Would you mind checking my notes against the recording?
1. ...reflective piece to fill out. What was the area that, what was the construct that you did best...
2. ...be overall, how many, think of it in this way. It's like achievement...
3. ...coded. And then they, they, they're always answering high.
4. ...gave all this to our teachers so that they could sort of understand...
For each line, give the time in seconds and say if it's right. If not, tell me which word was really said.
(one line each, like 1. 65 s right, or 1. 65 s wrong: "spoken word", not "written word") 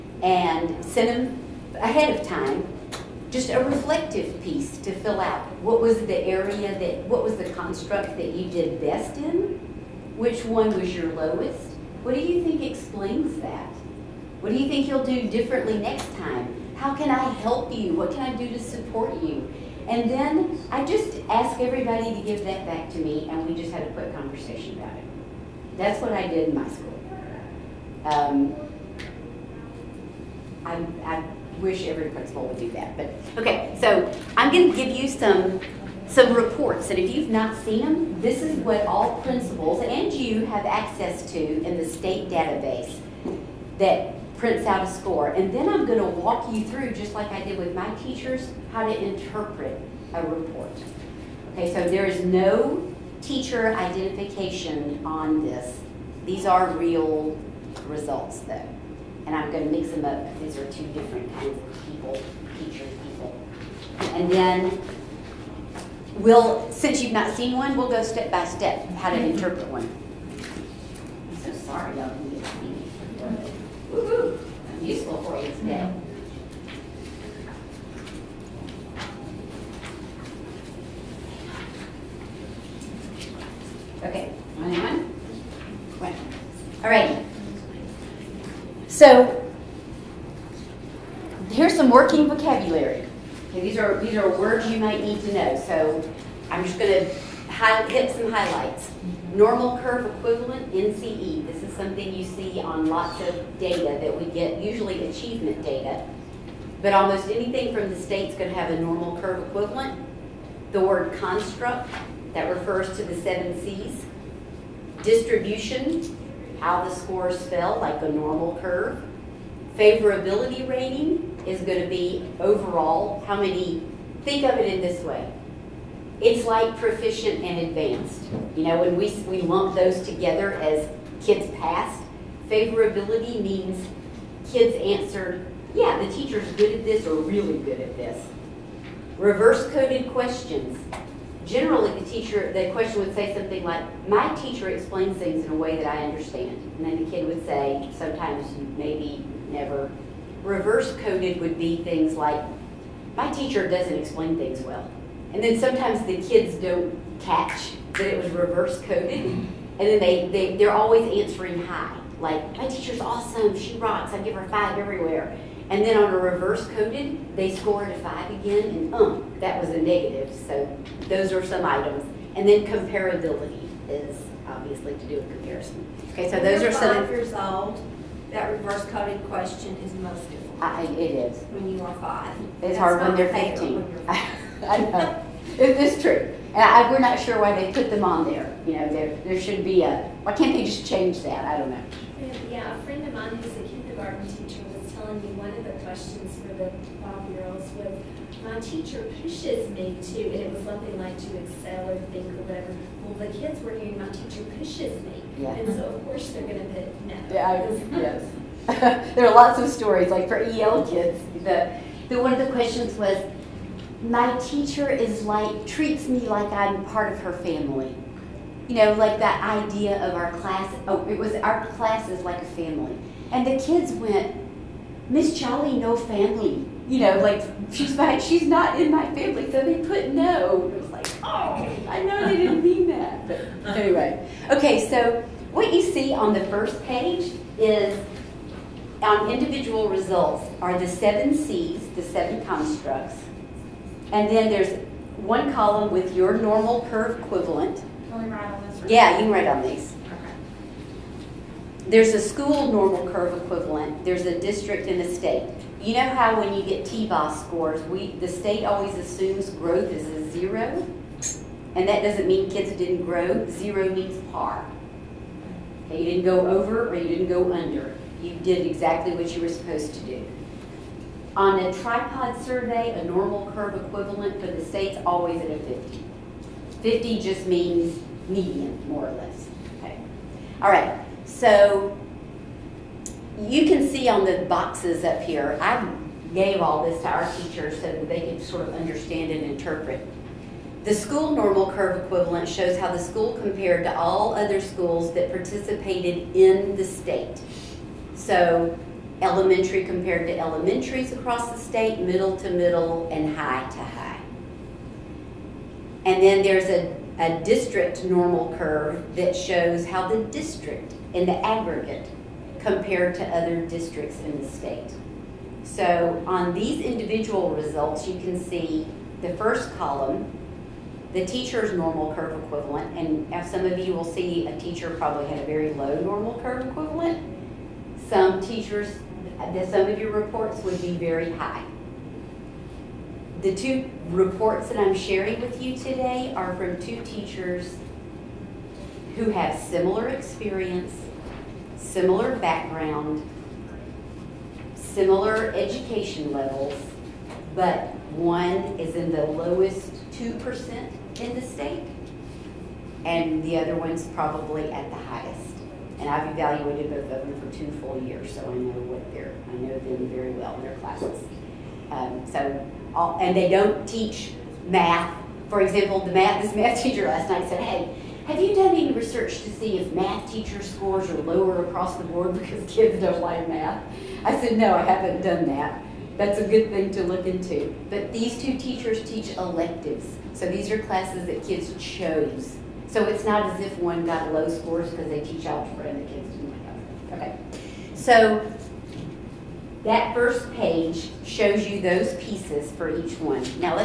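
1. 3 s right
2. 121 s wrong: "proficient", not "achievement"
3. 158 s right
4. 286 s right.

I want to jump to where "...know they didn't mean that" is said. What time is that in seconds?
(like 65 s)
232 s.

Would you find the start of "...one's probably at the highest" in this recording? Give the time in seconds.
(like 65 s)
353 s.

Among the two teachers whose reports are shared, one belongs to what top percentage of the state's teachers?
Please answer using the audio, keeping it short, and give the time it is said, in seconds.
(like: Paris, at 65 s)
2%, at 349 s.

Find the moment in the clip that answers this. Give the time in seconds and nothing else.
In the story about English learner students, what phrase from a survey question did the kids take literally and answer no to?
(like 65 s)
221 s.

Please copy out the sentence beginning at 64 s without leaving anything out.
And then we'll, since you've not seen one, we'll go step by step how to interpret one.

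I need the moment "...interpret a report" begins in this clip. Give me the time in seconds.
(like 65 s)
48 s.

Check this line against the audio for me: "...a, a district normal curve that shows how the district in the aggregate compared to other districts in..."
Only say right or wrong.
right.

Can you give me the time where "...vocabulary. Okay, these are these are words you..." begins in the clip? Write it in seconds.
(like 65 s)
92 s.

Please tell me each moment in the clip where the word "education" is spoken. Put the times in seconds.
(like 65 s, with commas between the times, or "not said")
345 s.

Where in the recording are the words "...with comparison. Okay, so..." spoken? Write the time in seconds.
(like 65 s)
175 s.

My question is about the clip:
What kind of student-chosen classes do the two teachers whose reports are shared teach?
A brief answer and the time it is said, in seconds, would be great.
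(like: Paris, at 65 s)
Electives, at 379 s.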